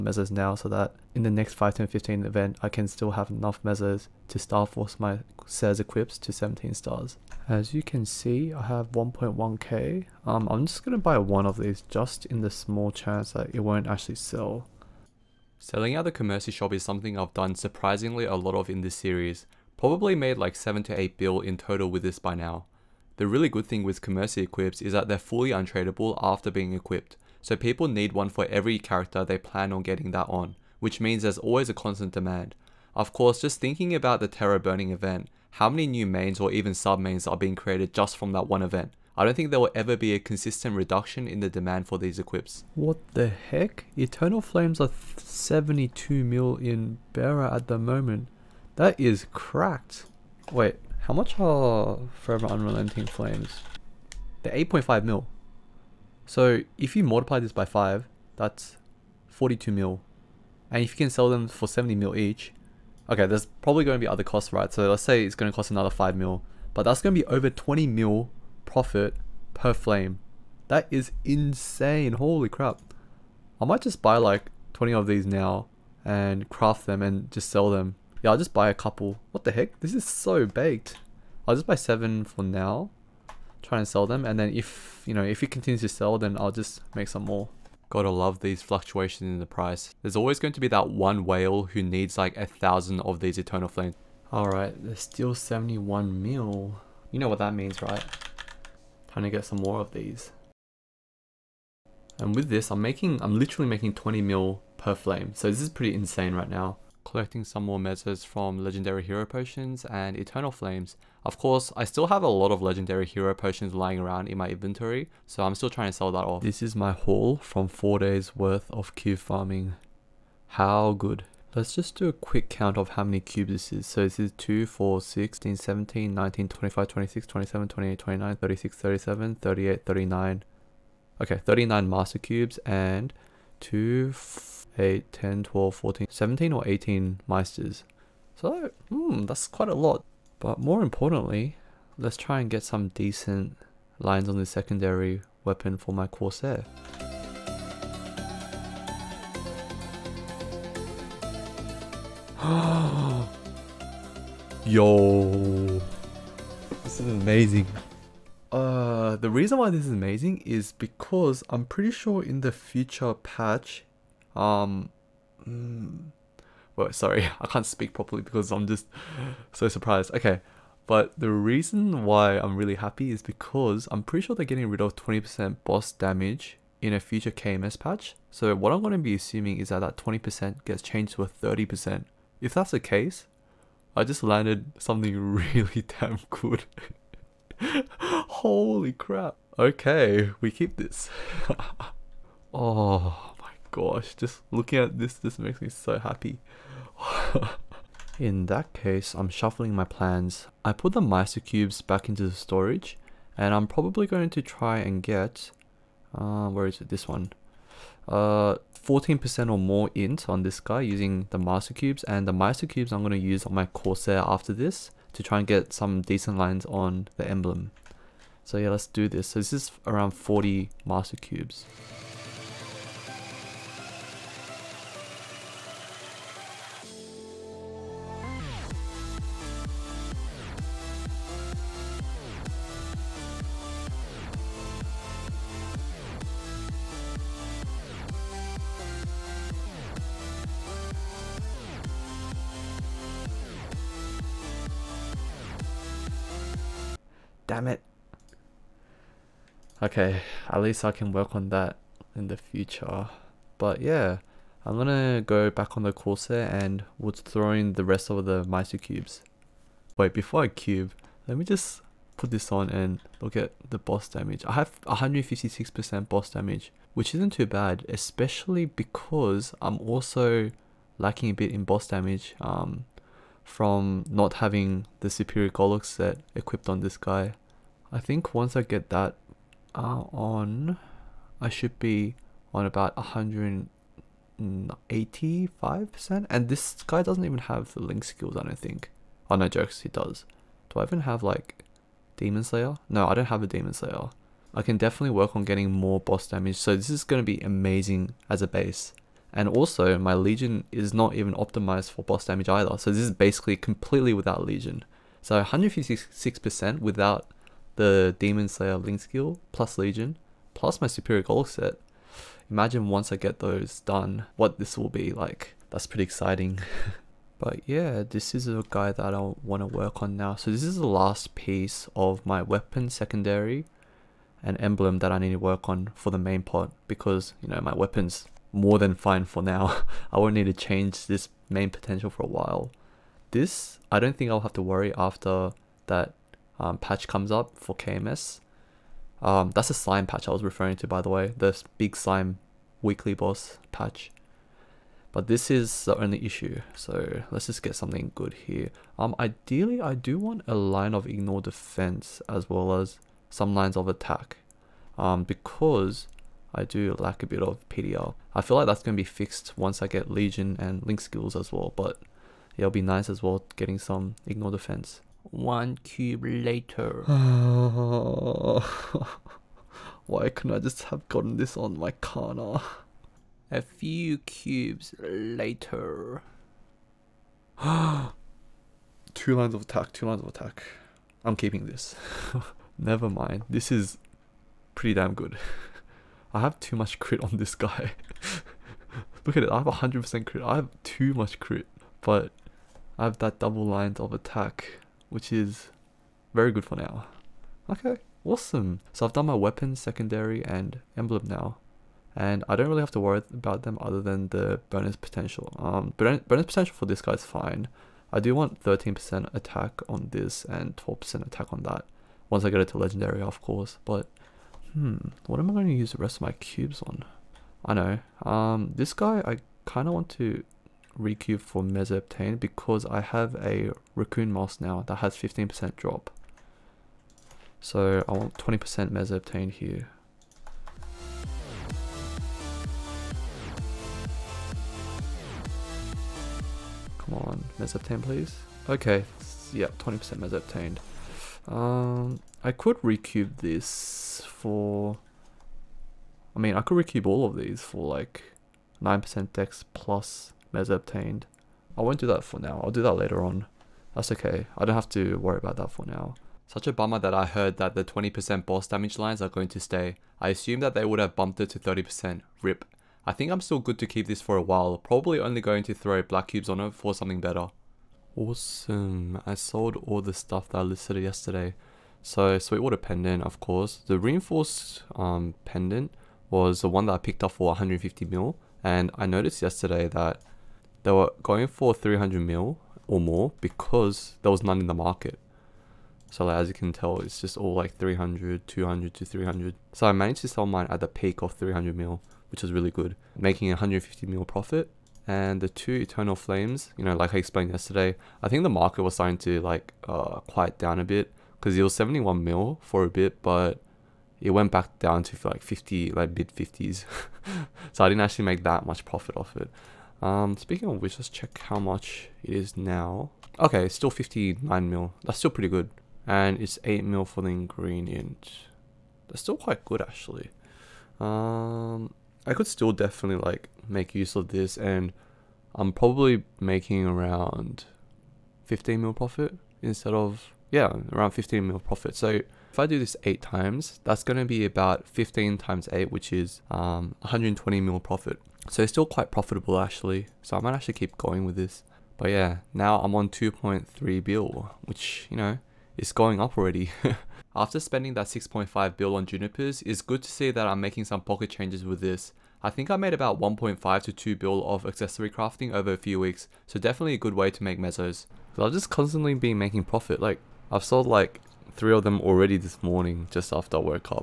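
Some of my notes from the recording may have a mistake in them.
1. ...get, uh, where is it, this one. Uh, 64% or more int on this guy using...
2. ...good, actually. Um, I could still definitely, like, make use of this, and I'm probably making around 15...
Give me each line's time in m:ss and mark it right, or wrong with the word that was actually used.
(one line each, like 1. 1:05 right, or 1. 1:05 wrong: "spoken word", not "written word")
1. 3:25 wrong: "14", not "64"
2. 8:39 right.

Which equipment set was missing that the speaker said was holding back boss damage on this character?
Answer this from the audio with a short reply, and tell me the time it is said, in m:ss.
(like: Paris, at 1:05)
superior Gollux set, at 4:35.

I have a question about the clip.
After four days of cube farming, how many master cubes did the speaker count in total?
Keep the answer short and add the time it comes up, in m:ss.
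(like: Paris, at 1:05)
39, at 2:11.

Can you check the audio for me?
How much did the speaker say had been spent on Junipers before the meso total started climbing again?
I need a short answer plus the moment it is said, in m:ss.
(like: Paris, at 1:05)
6.5 bill, at 9:08.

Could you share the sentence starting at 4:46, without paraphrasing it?
And this guy doesn't even have the link skills, I don't think.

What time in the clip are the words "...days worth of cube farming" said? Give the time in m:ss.
1:57.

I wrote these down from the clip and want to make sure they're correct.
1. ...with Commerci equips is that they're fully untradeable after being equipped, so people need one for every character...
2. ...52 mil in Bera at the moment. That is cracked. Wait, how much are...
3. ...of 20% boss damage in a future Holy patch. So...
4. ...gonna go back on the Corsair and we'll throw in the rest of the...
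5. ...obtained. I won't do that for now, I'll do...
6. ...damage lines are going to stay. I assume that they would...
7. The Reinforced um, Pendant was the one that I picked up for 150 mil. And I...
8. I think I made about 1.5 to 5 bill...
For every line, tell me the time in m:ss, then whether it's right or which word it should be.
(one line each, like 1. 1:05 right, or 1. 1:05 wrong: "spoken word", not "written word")
1. 0:23 right
2. 0:45 wrong: "72", not "52"
3. 2:54 wrong: "KMS", not "Holy"
4. 4:14 right
5. 7:30 right
6. 7:38 right
7. 7:53 right
8. 9:12 wrong: "2", not "5".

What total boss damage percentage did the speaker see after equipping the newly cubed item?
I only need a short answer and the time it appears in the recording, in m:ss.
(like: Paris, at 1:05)
156%, at 4:24.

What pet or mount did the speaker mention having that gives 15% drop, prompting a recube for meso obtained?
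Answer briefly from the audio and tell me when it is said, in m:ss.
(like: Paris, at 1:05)
Raccoon Moss, at 7:03.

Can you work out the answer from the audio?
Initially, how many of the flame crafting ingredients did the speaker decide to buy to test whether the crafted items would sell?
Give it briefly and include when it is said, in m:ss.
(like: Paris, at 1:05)
seven, at 1:21.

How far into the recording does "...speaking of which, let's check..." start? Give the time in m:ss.
8:30.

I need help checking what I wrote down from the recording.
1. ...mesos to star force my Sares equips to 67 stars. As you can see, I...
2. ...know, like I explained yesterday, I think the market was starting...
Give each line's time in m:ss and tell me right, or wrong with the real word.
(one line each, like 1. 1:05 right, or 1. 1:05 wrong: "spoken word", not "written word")
1. 0:03 wrong: "17", not "67"
2. 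8:16 right.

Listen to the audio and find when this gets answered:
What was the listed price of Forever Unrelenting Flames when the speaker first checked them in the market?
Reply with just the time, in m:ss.
0:54.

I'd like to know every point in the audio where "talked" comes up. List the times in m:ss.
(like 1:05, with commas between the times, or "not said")
not said.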